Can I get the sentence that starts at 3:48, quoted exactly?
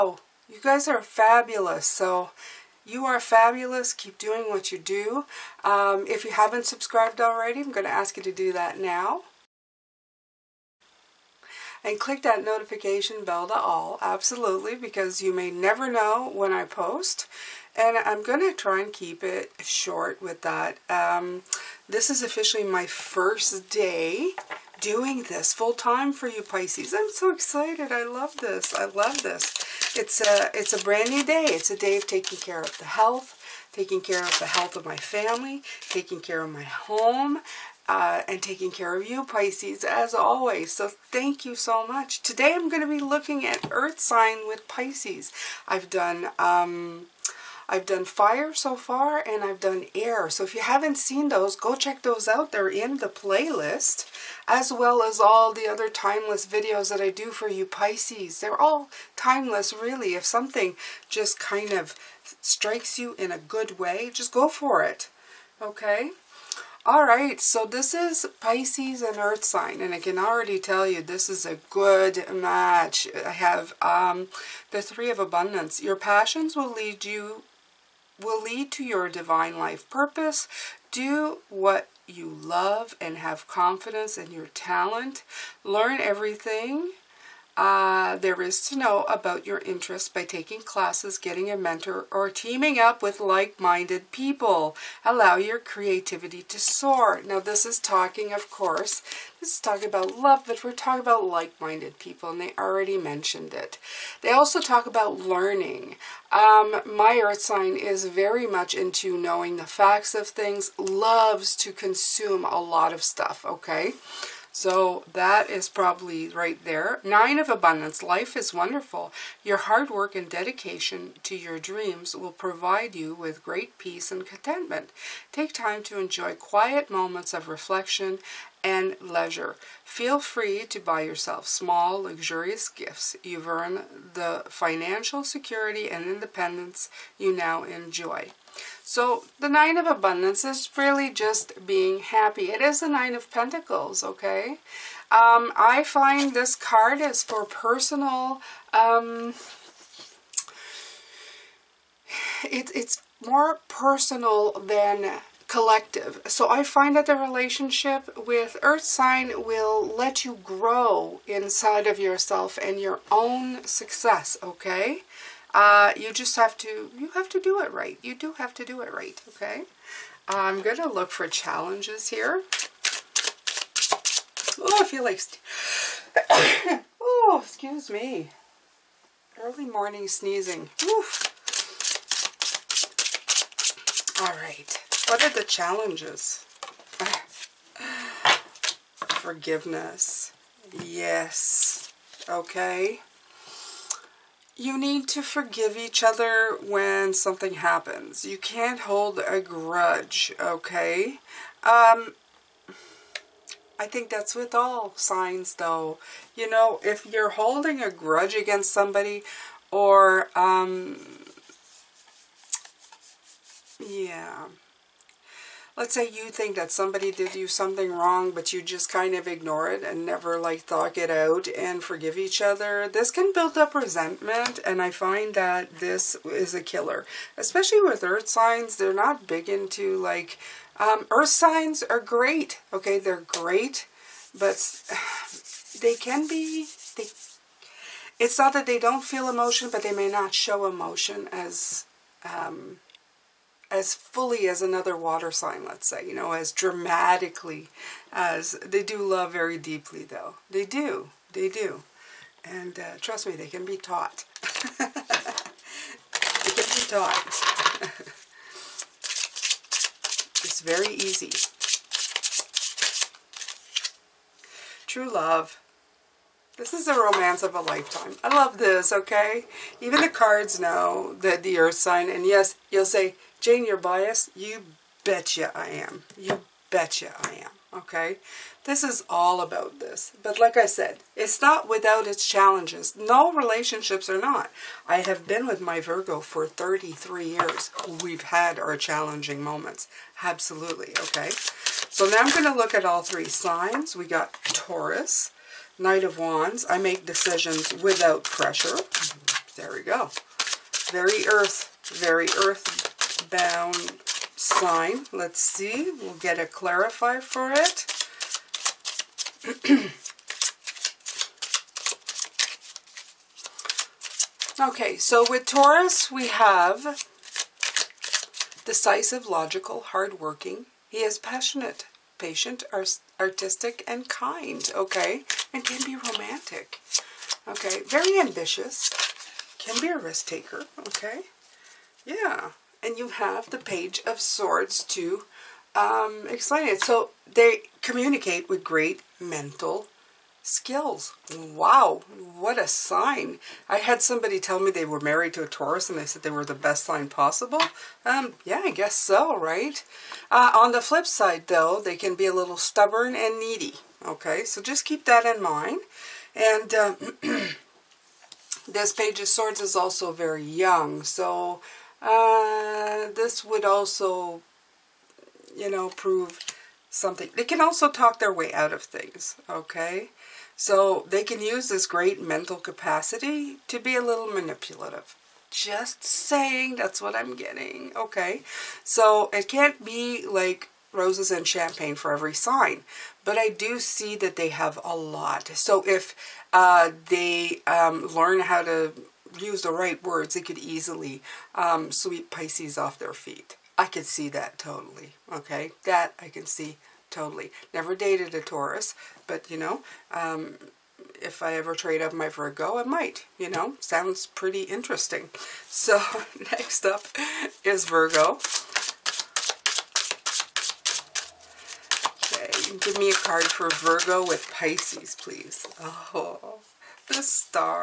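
They're not big into like um, earth signs are great.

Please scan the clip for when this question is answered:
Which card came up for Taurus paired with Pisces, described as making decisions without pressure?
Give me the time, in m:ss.
4:55.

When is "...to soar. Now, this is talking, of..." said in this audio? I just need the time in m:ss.
1:36.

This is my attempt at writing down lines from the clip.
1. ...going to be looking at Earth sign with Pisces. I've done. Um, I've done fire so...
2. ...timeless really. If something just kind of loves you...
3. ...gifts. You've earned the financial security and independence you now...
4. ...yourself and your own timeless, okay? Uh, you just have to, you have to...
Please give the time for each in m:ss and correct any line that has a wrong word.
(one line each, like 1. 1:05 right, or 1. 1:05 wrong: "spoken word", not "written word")
1. 0:42 right
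2. 0:59 wrong: "strikes", not "loves"
3. 2:12 right
4. 2:41 wrong: "success", not "timeless".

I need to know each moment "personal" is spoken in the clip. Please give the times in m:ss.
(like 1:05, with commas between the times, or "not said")
2:27, 2:33.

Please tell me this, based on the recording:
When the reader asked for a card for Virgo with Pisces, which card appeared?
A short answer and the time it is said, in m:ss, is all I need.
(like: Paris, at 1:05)
The Star, at 6:57.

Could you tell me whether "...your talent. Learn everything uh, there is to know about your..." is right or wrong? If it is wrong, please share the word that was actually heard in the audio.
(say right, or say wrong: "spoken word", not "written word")
right.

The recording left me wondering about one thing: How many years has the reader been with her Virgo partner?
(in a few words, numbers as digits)
33.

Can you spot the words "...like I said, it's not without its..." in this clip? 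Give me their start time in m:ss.
4:40.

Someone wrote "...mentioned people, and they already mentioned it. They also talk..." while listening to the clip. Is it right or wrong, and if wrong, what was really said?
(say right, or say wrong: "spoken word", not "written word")
wrong: "minded", not "mentioned".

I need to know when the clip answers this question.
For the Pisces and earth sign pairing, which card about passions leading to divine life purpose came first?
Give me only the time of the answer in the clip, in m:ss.
1:14.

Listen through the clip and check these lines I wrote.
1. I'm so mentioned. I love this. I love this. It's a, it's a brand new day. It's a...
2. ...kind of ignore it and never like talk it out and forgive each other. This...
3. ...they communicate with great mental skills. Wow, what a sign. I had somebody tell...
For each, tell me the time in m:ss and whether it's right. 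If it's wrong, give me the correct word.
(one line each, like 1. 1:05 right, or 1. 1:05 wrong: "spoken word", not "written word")
1. 0:26 wrong: "excited", not "mentioned"
2. 3:38 right
3. 5:37 right.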